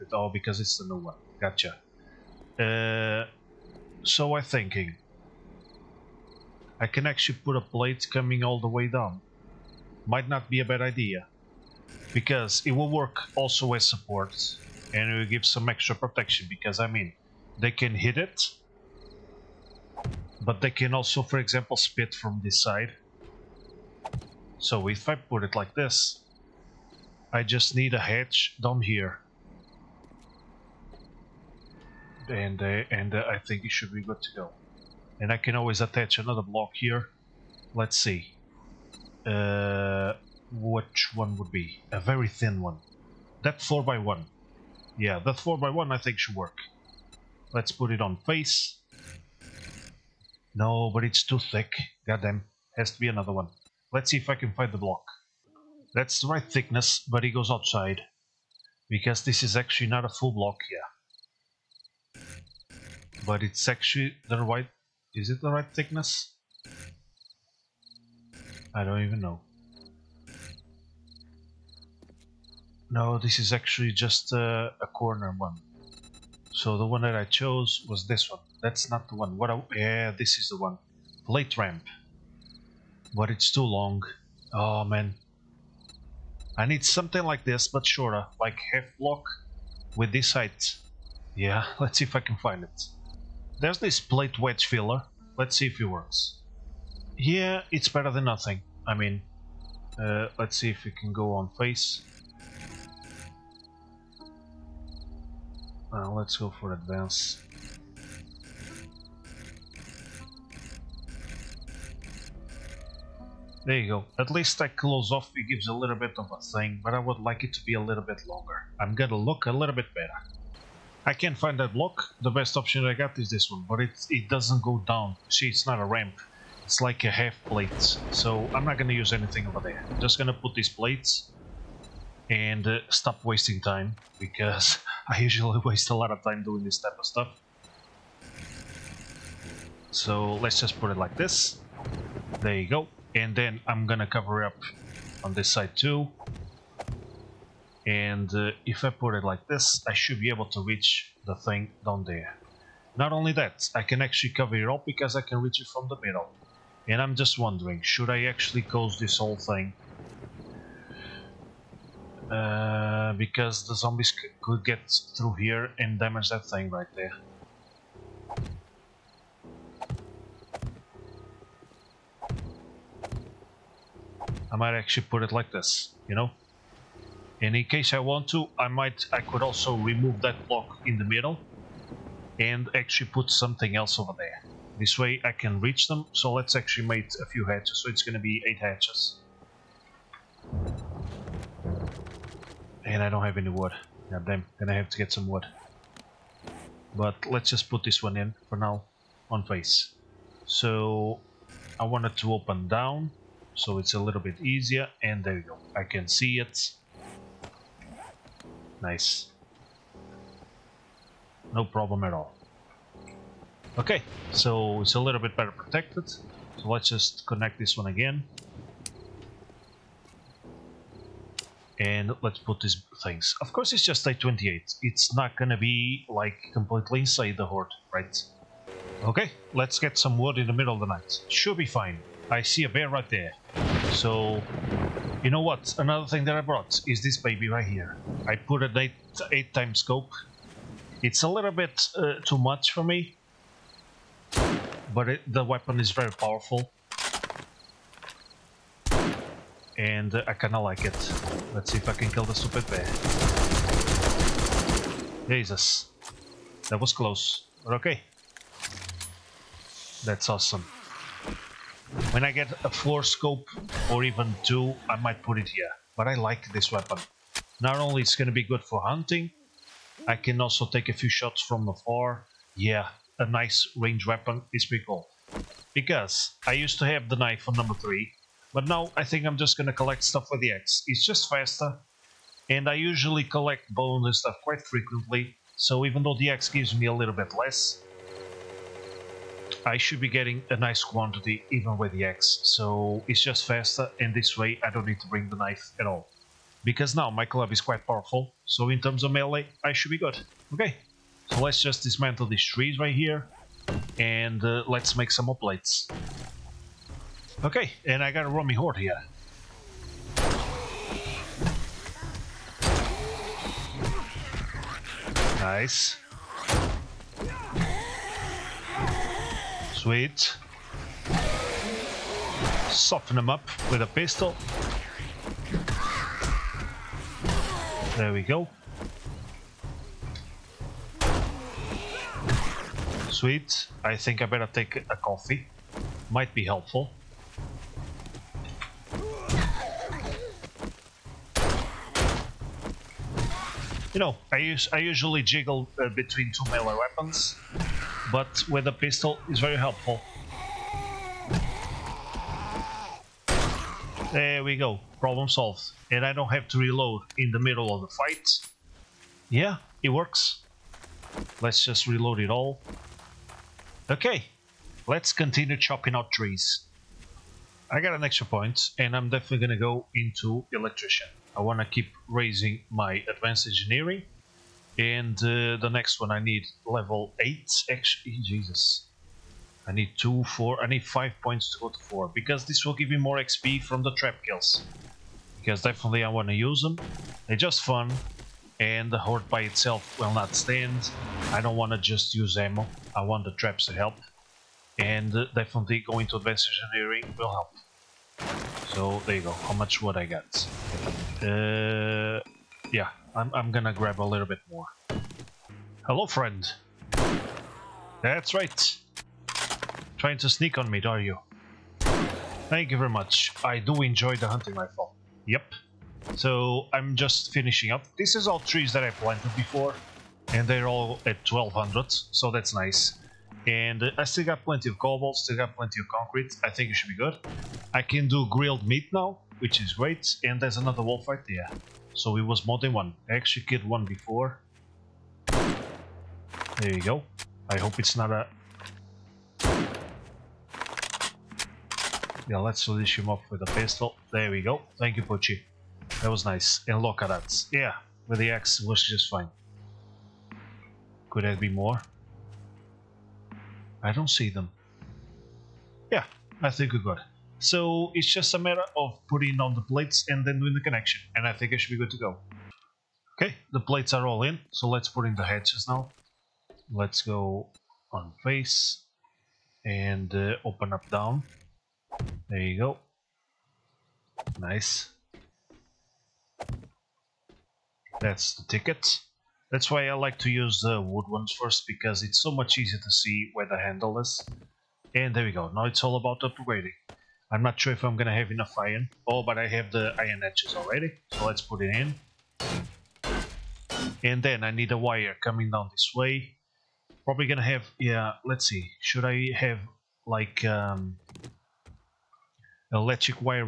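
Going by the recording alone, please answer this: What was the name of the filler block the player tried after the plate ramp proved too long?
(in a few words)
plate wedge filler.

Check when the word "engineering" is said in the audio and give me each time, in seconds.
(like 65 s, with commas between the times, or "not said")
373 s, 396 s.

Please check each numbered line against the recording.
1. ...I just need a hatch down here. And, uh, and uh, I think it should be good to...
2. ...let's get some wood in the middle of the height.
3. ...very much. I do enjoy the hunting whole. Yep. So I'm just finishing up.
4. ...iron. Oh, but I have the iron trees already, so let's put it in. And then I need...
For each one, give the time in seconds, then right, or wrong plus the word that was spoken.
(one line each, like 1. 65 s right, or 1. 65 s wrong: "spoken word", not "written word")
1. 27 s right
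2. 229 s wrong: "night", not "height"
3. 412 s wrong: "rifle", not "whole"
4. 488 s wrong: "edges", not "trees".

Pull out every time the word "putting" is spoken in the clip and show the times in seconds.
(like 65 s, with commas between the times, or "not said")
459 s.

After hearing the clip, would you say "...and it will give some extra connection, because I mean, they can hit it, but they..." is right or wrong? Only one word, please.
wrong.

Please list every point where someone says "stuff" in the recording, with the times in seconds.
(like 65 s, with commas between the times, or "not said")
137 s, 280 s, 284 s.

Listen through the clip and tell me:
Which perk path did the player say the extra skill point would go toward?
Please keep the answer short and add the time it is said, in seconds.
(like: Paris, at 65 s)
electrician, at 370 s.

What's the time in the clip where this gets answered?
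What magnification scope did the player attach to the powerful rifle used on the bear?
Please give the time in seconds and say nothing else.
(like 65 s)
239 s.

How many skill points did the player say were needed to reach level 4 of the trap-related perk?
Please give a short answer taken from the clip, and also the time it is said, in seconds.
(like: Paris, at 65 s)
5, at 380 s.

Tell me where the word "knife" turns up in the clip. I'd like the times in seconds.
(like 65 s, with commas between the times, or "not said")
277 s, 295 s.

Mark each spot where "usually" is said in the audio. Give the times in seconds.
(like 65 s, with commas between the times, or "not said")
135 s, 282 s, 344 s.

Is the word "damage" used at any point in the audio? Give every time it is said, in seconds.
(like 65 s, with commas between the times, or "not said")
165 s.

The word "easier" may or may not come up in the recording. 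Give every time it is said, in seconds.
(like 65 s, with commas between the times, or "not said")
204 s, 482 s.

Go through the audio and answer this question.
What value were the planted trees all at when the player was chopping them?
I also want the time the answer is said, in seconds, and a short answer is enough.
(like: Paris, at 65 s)
1200, at 421 s.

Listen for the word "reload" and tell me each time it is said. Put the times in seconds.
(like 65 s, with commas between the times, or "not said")
356 s, 361 s.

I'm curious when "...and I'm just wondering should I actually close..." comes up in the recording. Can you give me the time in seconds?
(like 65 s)
156 s.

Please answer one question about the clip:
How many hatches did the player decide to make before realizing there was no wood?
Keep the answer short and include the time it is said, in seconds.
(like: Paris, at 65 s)
8, at 188 s.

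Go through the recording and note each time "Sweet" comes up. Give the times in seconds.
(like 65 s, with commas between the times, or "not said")
319 s, 333 s.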